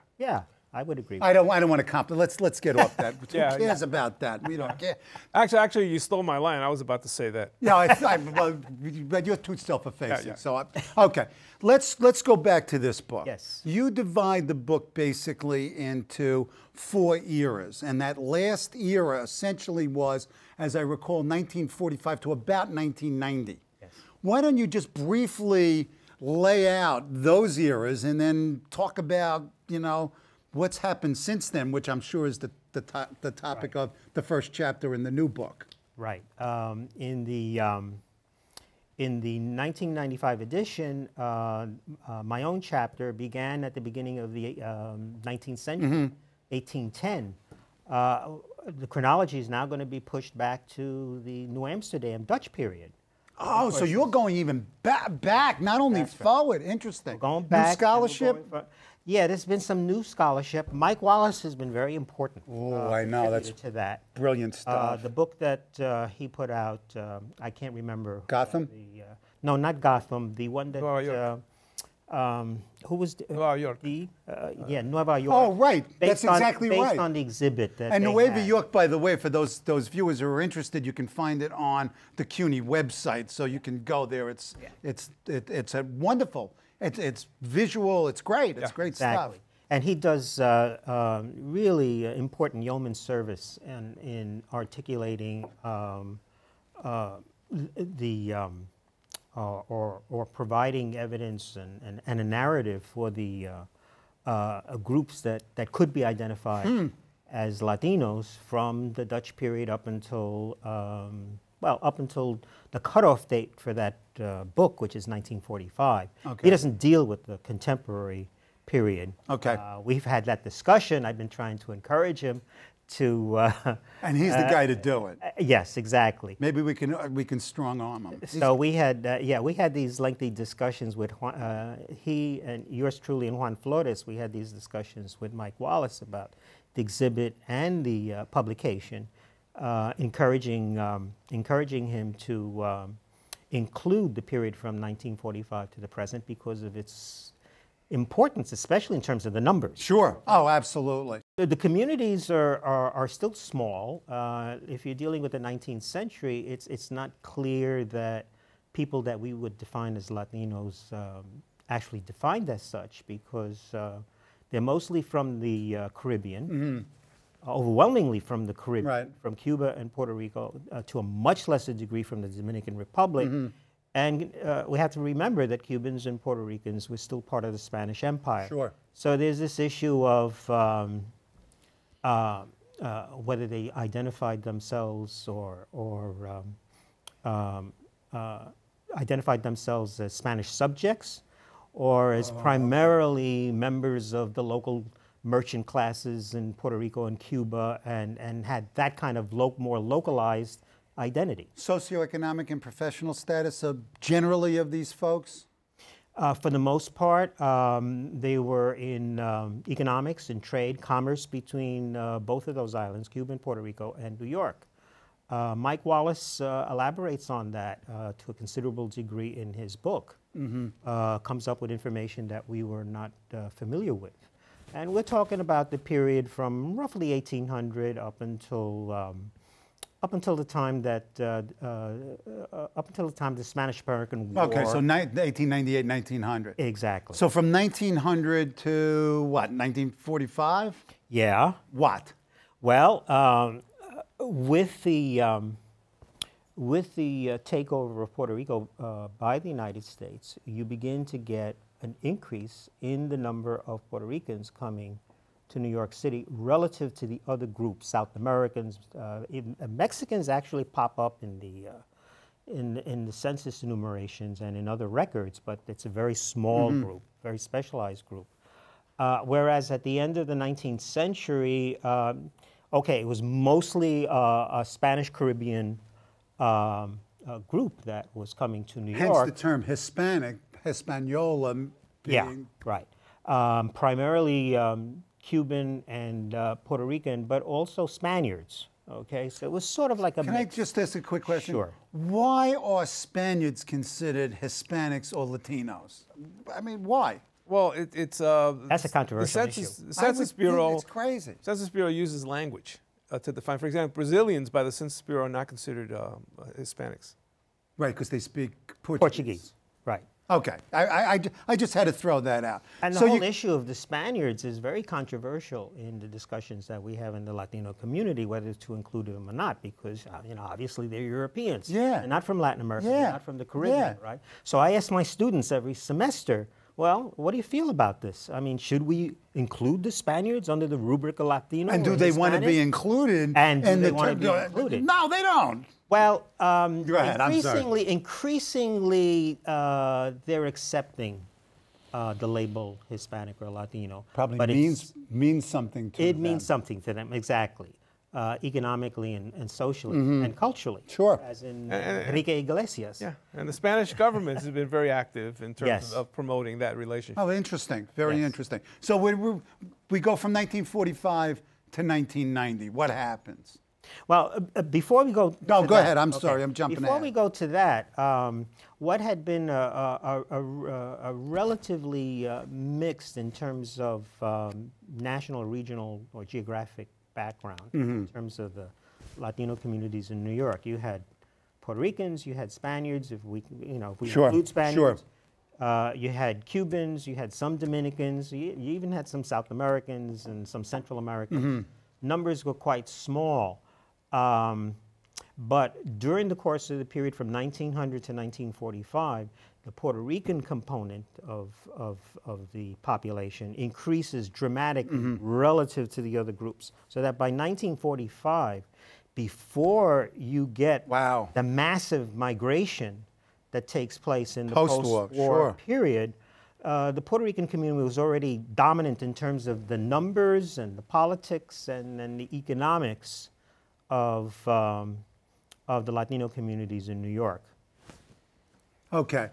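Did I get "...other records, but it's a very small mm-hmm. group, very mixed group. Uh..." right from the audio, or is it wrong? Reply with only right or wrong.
wrong.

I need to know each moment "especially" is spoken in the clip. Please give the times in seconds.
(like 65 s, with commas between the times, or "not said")
148 s.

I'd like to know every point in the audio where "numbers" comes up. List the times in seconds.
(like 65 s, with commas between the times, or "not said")
149 s, 253 s, 391 s, 419 s.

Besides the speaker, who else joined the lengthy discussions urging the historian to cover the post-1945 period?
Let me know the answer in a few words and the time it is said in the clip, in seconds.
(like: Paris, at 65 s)
Juan Flores, at 133 s.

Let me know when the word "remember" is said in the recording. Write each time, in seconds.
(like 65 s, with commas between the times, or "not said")
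67 s, 174 s.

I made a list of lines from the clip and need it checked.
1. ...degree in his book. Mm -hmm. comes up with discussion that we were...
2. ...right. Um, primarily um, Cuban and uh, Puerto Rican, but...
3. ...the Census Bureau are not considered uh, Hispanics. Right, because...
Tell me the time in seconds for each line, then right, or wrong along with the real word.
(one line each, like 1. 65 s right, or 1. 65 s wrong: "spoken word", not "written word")
1. 218 s wrong: "information", not "discussion"
2. 282 s right
3. 304 s right.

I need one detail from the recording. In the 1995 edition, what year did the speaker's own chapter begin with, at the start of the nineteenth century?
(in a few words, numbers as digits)
1810.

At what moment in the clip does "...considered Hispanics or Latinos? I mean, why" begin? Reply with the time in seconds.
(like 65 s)
293 s.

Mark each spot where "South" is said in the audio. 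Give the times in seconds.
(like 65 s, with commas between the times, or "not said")
257 s, 389 s.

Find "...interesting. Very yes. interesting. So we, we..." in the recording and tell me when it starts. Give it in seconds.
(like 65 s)
357 s.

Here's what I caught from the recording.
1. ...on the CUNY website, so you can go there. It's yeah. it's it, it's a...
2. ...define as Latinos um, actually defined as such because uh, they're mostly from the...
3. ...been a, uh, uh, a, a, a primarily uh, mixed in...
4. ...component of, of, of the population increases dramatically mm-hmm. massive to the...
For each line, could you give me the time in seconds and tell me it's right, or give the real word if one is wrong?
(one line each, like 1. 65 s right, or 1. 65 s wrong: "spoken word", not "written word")
1. 81 s right
2. 159 s right
3. 369 s wrong: "relatively", not "primarily"
4. 400 s wrong: "relative", not "massive".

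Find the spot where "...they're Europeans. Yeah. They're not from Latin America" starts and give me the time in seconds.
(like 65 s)
320 s.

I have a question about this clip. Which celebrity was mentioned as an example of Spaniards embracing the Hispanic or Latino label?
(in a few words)
Enrique Iglesias.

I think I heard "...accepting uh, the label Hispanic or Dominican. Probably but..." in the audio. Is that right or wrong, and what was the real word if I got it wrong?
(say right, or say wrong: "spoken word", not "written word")
wrong: "Latino", not "Dominican".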